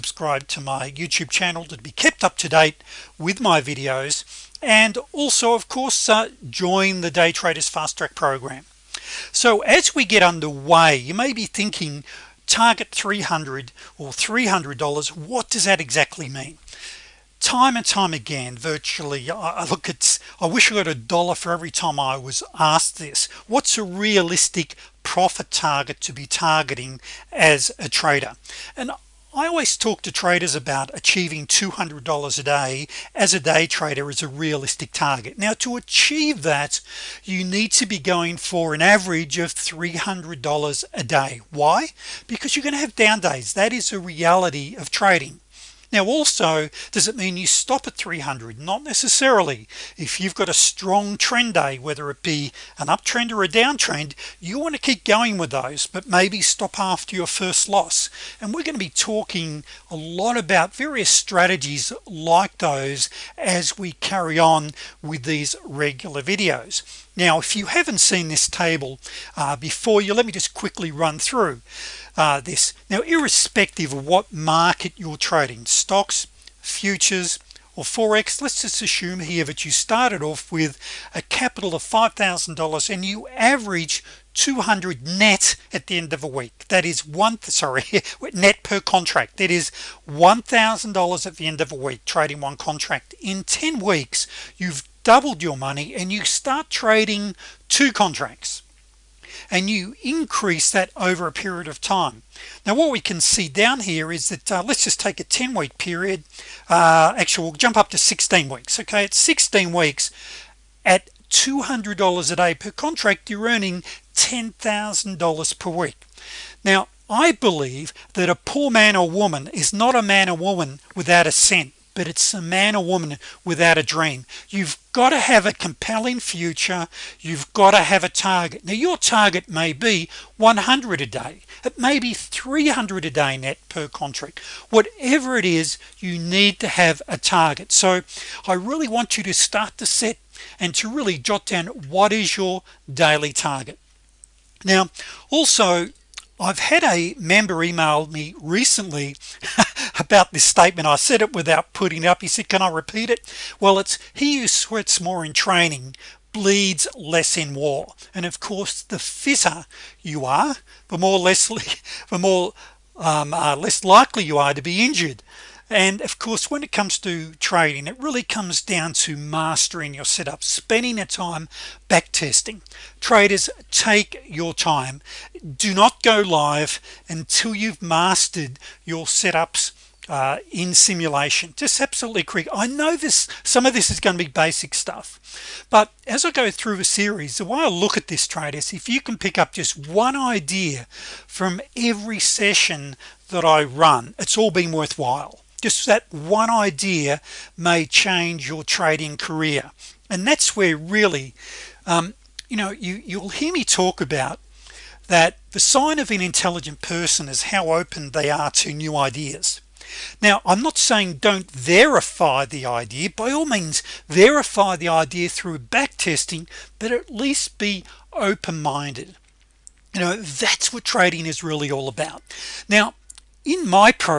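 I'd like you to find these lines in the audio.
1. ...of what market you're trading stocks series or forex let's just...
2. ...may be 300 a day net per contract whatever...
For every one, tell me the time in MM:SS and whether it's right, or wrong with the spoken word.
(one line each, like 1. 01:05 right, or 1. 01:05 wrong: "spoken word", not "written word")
1. 01:13 wrong: "futures", not "series"
2. 02:11 right.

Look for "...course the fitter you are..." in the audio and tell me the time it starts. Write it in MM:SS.
02:38.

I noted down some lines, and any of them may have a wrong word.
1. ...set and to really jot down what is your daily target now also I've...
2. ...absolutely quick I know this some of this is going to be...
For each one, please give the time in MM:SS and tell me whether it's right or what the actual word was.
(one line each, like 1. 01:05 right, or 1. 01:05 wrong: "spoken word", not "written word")
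1. 02:19 right
2. 03:01 right.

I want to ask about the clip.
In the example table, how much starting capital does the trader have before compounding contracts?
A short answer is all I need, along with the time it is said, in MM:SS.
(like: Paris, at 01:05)
$5,000, at 01:21.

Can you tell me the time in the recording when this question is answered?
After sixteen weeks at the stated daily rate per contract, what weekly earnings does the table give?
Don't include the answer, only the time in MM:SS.
01:54.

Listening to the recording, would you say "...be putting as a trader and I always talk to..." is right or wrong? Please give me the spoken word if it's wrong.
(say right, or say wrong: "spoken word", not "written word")
wrong: "targeting", not "putting".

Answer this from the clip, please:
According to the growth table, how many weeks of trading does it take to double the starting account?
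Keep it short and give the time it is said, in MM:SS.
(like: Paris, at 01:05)
10 weeks, at 01:33.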